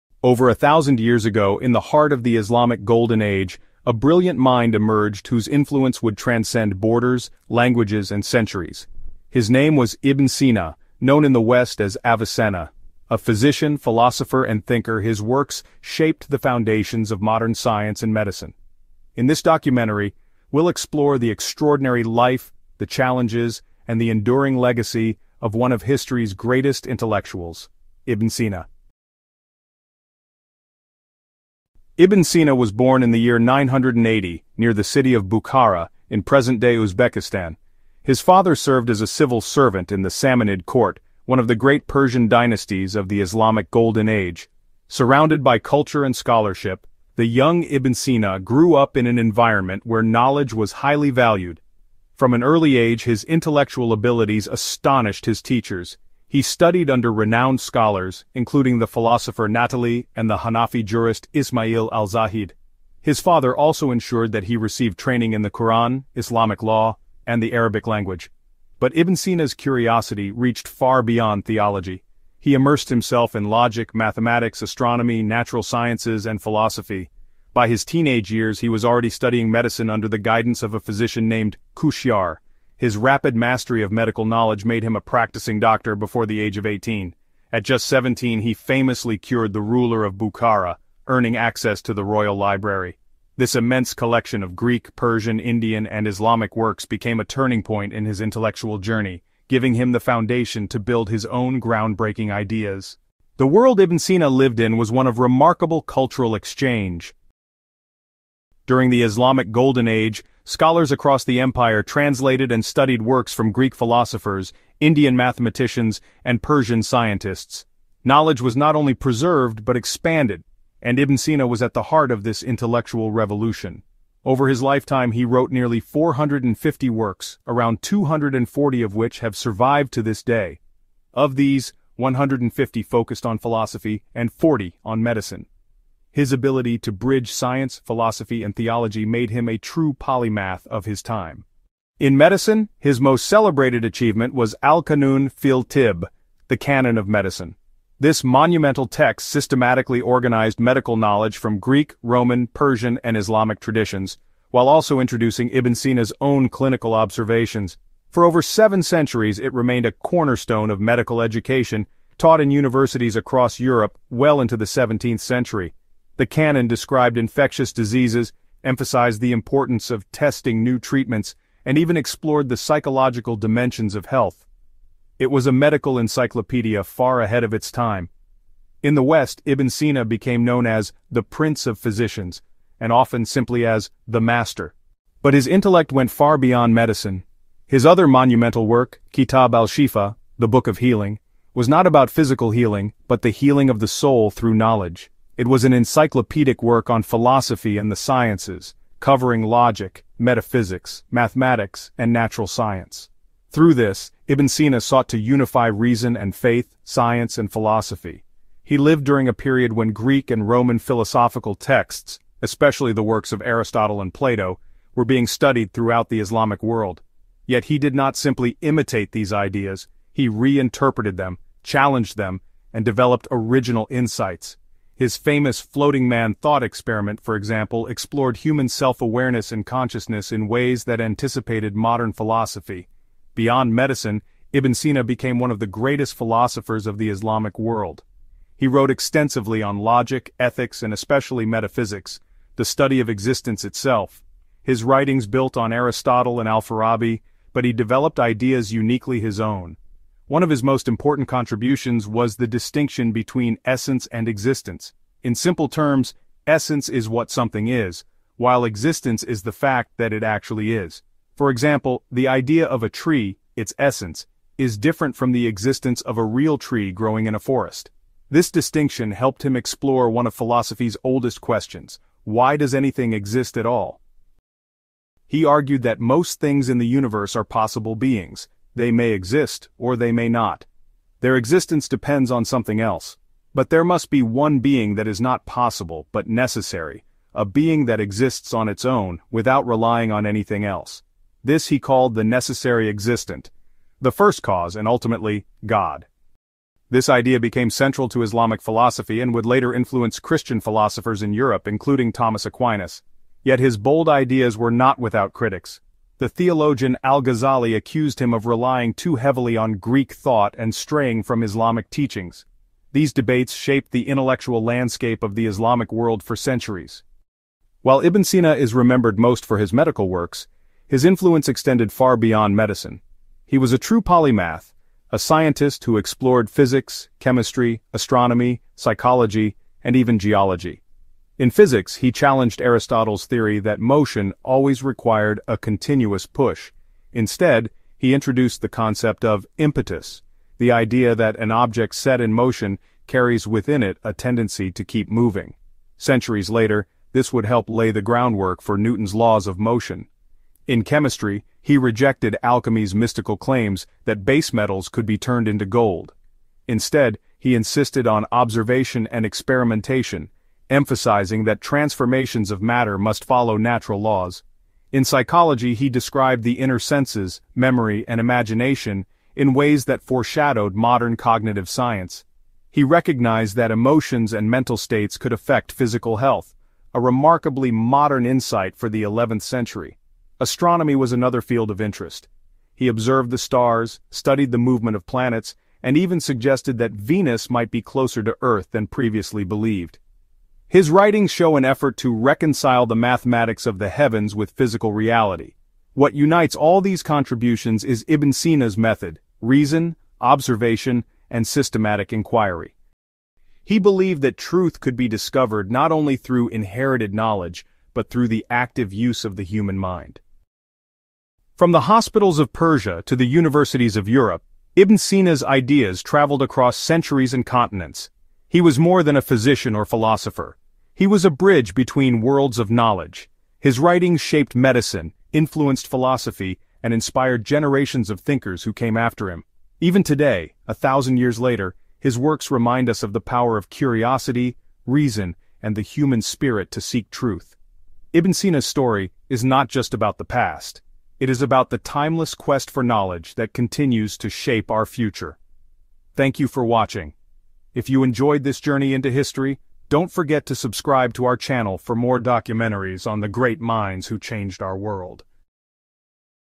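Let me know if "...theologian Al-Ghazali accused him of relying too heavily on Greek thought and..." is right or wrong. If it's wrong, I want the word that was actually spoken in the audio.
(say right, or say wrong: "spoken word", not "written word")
right.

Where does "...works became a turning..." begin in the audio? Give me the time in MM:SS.
01:36.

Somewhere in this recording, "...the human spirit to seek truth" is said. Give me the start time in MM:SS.
07:15.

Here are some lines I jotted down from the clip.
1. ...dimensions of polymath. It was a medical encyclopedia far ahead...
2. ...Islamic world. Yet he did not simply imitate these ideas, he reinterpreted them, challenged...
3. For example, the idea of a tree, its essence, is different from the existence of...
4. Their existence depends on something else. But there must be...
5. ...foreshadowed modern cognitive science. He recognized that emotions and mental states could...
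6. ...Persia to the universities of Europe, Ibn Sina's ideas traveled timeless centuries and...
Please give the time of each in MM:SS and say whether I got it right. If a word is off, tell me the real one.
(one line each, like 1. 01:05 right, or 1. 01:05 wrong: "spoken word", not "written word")
1. 02:53 wrong: "health", not "polymath"
2. 03:36 right
3. 04:21 right
4. 04:41 right
5. 06:10 right
6. 06:52 wrong: "across", not "timeless".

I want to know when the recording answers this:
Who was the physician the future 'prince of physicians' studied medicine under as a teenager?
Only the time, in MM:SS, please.
01:21.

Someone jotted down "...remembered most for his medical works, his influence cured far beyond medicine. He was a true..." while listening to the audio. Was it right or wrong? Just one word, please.
wrong.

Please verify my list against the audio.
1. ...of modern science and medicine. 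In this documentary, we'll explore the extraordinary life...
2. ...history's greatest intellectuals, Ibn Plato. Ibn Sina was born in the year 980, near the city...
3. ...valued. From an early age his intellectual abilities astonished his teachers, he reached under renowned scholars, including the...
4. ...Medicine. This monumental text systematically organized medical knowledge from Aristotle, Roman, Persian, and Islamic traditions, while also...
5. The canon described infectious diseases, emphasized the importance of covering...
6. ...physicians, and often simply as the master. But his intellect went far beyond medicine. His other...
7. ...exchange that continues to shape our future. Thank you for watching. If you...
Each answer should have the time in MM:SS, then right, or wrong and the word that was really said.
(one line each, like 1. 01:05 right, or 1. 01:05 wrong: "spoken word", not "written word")
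1. 00:17 right
2. 00:25 wrong: "Sina", not "Plato"
3. 00:51 wrong: "studied", not "reached"
4. 02:27 wrong: "Greek", not "Aristotle"
5. 02:46 wrong: "testing", not "covering"
6. 03:01 right
7. 07:22 wrong: "knowledge", not "exchange".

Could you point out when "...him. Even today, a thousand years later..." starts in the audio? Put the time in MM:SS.
07:09.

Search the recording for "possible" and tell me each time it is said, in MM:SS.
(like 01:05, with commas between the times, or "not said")
04:37, 04:45.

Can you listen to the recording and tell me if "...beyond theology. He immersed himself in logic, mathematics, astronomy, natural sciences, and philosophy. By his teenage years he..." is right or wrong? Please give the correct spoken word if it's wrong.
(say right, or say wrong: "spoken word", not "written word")
right.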